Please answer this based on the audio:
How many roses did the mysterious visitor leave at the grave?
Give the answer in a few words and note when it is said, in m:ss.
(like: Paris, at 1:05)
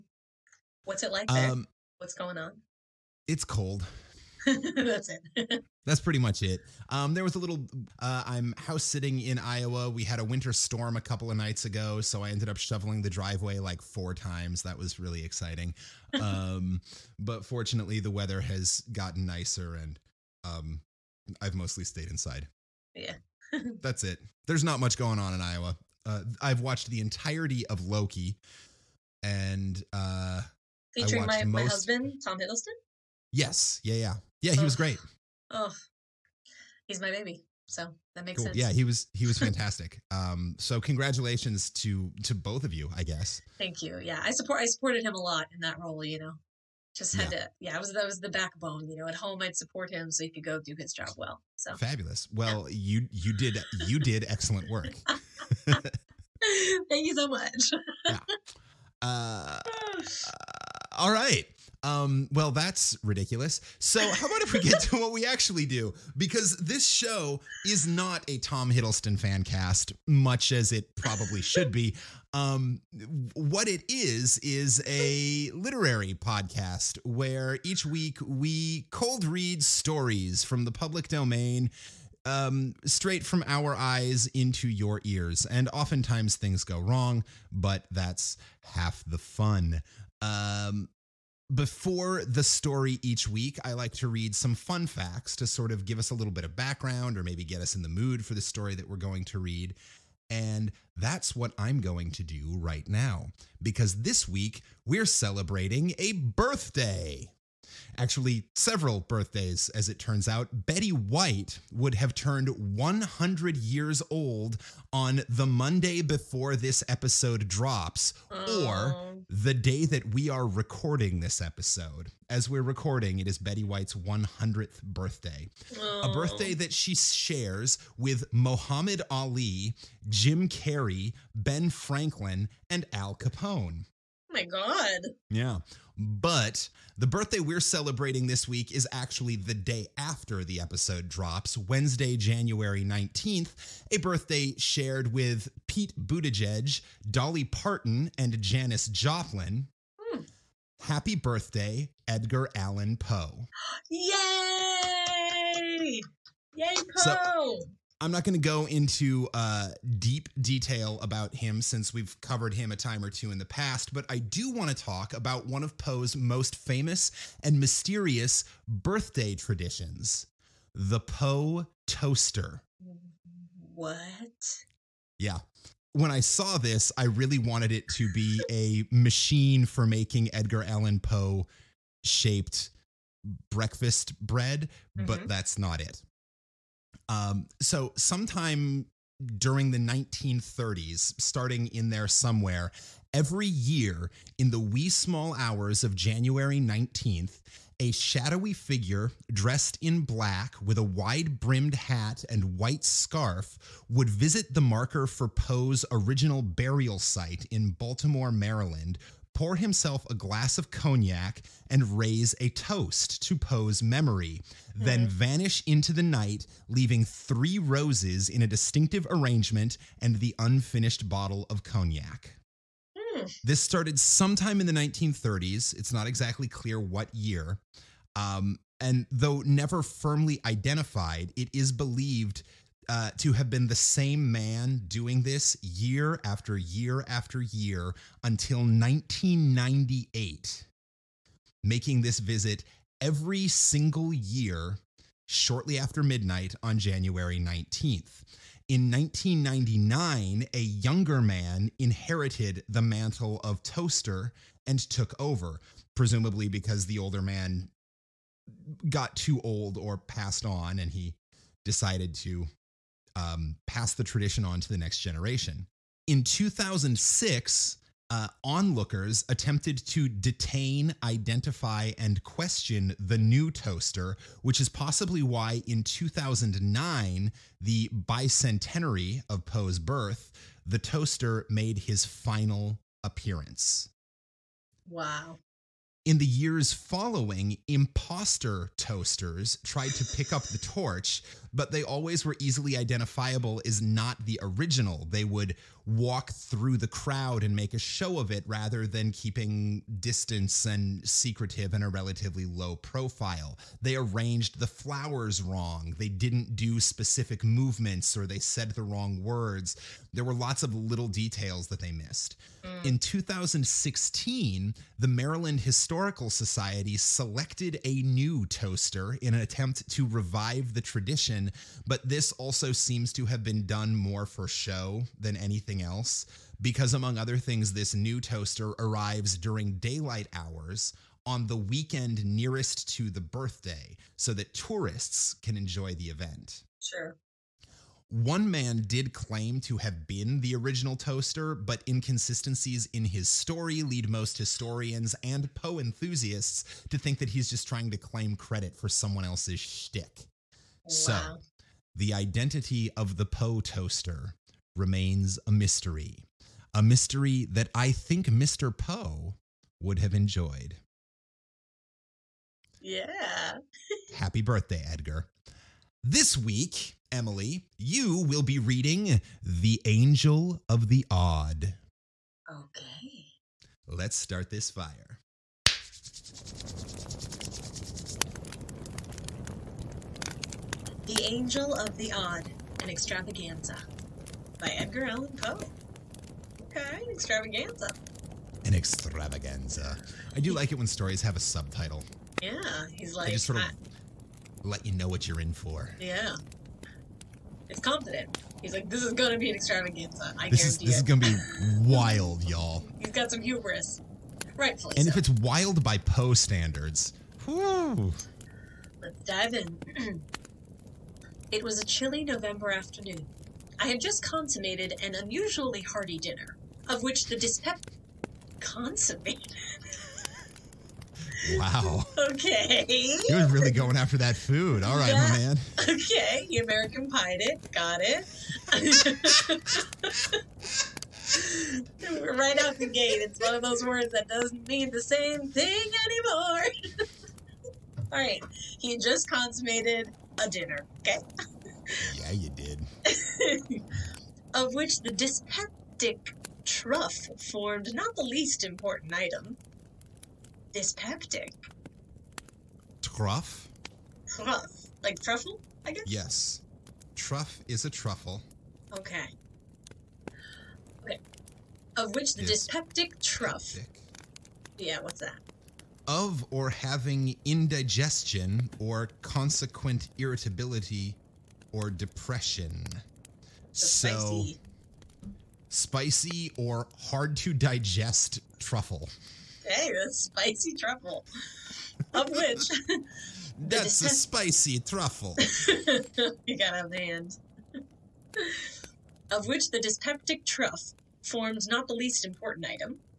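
3, at 3:37.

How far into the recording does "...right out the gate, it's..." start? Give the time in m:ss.
7:12.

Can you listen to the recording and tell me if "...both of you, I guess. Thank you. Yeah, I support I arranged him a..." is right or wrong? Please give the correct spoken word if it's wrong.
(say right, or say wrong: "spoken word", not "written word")
wrong: "supported", not "arranged".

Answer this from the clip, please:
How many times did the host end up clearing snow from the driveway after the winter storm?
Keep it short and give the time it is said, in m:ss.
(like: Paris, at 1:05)
4, at 0:13.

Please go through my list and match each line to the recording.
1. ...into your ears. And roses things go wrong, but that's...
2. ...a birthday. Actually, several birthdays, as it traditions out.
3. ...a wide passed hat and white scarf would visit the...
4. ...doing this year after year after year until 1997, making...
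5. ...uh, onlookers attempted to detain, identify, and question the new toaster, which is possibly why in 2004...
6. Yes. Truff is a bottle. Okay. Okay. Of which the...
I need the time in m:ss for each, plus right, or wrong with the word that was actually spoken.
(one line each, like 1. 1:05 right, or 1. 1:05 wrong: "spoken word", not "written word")
1. 1:24 wrong: "oftentimes", not "roses"
2. 1:45 wrong: "turns", not "traditions"
3. 3:20 wrong: "brimmed", not "passed"
4. 3:54 wrong: "1998", not "1997"
5. 4:28 wrong: "2009", not "2004"
6. 7:36 wrong: "truffle", not "bottle".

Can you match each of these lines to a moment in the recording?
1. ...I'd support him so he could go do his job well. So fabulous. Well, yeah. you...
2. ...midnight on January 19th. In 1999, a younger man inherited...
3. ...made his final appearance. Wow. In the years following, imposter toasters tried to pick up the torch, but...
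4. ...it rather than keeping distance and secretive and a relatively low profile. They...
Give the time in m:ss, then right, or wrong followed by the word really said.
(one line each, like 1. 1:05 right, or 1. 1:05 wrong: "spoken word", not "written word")
1. 0:49 right
2. 4:06 right
3. 4:41 right
4. 4:58 right.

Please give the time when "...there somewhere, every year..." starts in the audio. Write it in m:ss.
3:11.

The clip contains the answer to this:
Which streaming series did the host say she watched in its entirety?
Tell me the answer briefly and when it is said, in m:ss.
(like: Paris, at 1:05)
Loki, at 0:26.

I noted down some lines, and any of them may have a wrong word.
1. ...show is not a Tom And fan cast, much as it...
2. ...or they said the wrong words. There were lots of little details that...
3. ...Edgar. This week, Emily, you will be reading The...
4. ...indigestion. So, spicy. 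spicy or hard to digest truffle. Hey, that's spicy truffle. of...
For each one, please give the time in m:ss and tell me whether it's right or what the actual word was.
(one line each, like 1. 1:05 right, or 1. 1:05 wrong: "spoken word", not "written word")
1. 1:06 wrong: "Hiddleston", not "And"
2. 5:08 right
3. 6:04 right
4. 7:51 wrong: "depression", not "indigestion".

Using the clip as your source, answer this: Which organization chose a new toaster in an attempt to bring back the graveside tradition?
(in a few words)
Maryland Historical Society.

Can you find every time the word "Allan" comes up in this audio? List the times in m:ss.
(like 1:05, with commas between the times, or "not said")
2:32, 3:00, 6:25.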